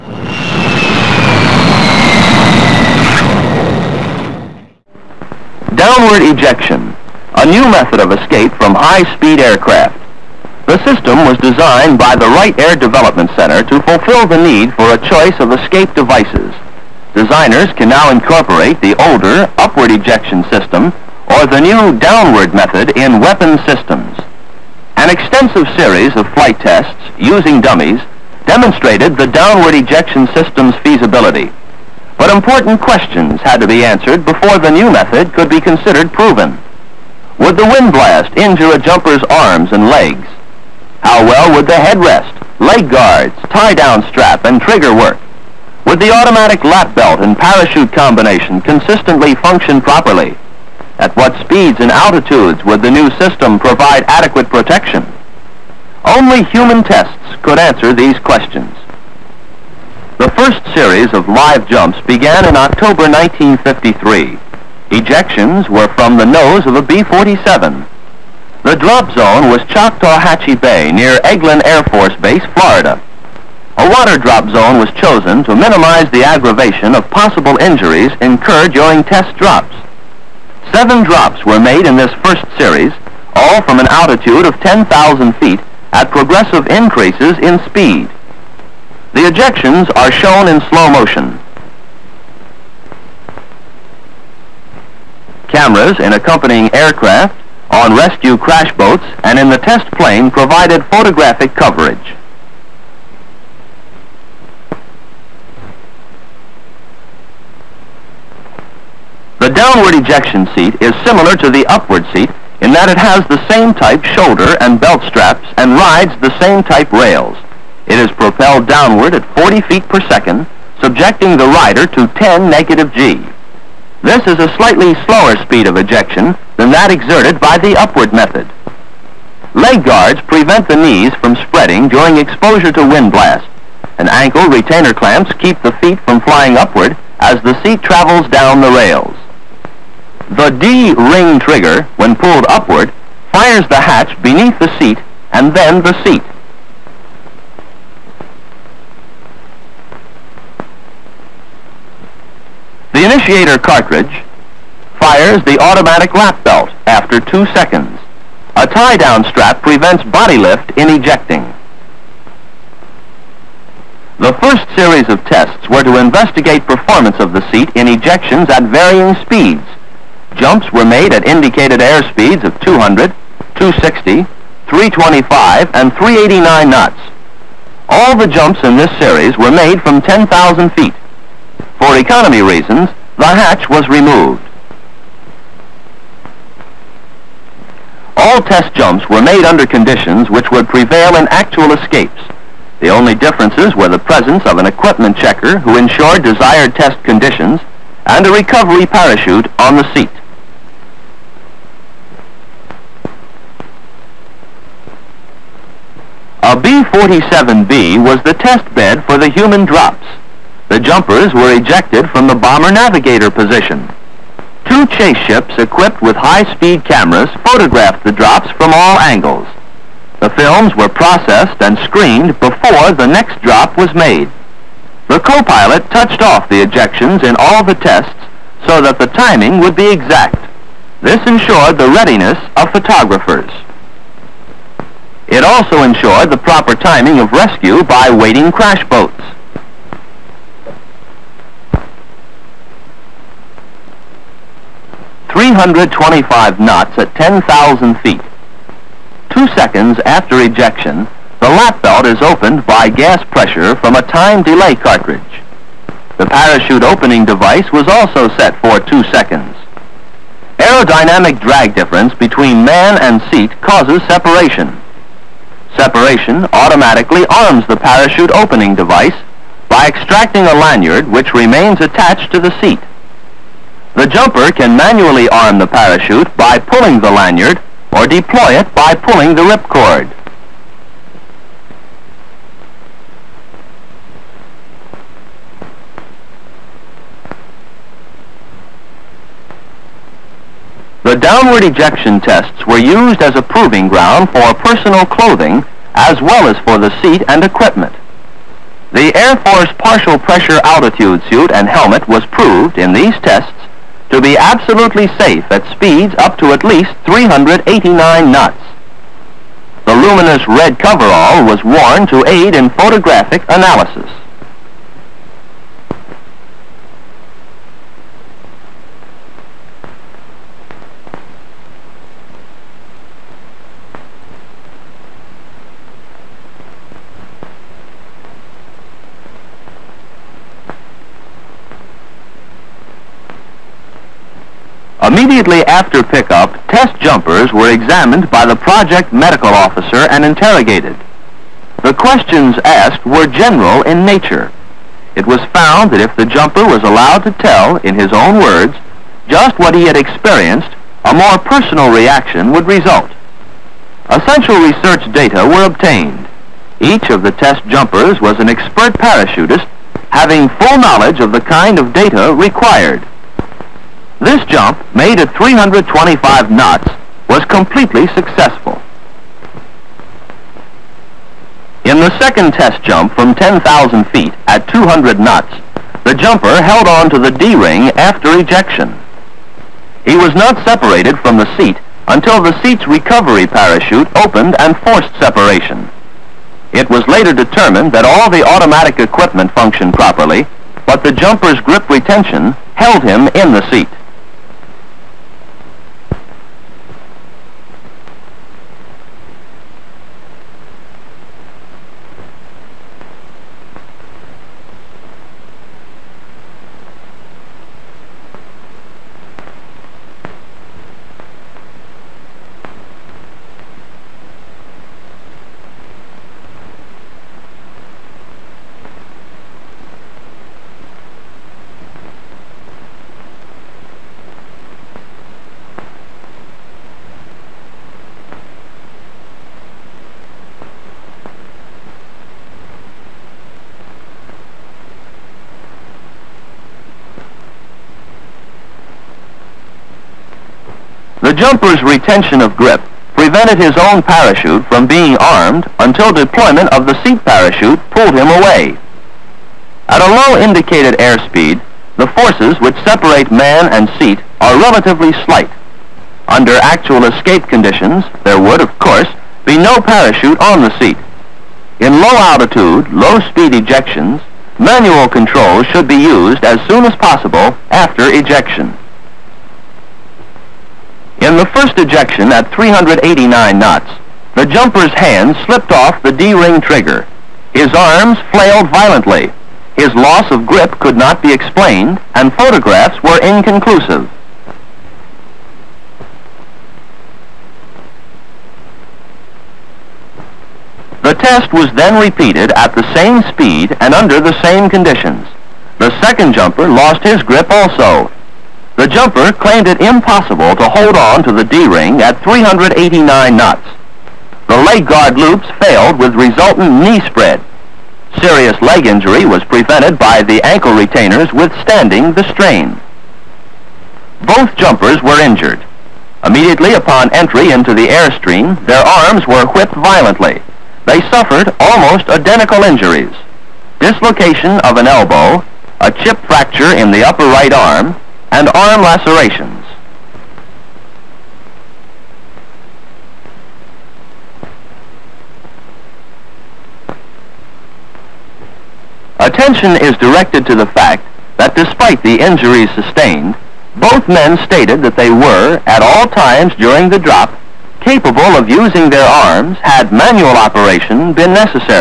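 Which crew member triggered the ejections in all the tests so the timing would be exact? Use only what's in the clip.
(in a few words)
co-pilot.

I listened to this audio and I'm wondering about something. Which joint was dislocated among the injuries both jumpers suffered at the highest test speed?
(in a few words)
elbow.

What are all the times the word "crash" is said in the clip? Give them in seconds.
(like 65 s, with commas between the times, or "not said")
98 s, 238 s.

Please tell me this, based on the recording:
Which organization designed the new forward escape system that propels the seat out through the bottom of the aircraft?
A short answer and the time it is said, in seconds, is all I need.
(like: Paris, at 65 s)
Wright Air Development Center, at 12 s.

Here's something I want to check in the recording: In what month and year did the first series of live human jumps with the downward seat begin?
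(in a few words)
October 1953.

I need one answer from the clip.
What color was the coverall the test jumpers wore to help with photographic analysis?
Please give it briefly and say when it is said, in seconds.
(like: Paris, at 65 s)
luminous red, at 309 s.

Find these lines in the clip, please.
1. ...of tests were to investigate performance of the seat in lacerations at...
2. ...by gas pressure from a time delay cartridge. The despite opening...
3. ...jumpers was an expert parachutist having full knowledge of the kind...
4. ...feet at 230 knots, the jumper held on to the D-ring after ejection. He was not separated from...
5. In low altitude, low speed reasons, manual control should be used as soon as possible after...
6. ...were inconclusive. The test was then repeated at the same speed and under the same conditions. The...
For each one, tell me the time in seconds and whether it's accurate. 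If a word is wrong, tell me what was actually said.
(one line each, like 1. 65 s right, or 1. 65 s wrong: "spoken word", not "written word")
1. 165 s wrong: "ejections", not "lacerations"
2. 252 s wrong: "parachute", not "despite"
3. 357 s right
4. 374 s wrong: "200", not "230"
5. 461 s wrong: "ejections", not "reasons"
6. 483 s right.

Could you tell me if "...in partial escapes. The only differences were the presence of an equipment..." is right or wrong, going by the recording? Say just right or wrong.
wrong.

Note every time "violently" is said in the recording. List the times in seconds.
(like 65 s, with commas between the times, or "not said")
478 s, 519 s.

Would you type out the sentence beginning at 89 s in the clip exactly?
The ejections are shown in slow motion.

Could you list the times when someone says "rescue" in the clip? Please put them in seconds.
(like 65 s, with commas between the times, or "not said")
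97 s, 237 s.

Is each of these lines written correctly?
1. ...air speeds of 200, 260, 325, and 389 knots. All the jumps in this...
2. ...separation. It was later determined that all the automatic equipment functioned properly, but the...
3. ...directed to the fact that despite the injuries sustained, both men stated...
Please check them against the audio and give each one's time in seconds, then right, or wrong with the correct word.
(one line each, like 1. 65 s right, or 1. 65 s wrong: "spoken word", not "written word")
1. 171 s right
2. 385 s right
3. 539 s right.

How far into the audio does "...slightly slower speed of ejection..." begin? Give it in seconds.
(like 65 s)
124 s.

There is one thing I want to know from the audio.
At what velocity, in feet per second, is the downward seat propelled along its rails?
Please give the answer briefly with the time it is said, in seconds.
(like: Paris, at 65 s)
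40, at 119 s.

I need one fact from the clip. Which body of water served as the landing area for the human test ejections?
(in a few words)
Choctawhatchee Bay.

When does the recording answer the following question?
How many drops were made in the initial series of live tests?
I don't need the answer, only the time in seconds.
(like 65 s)
80 s.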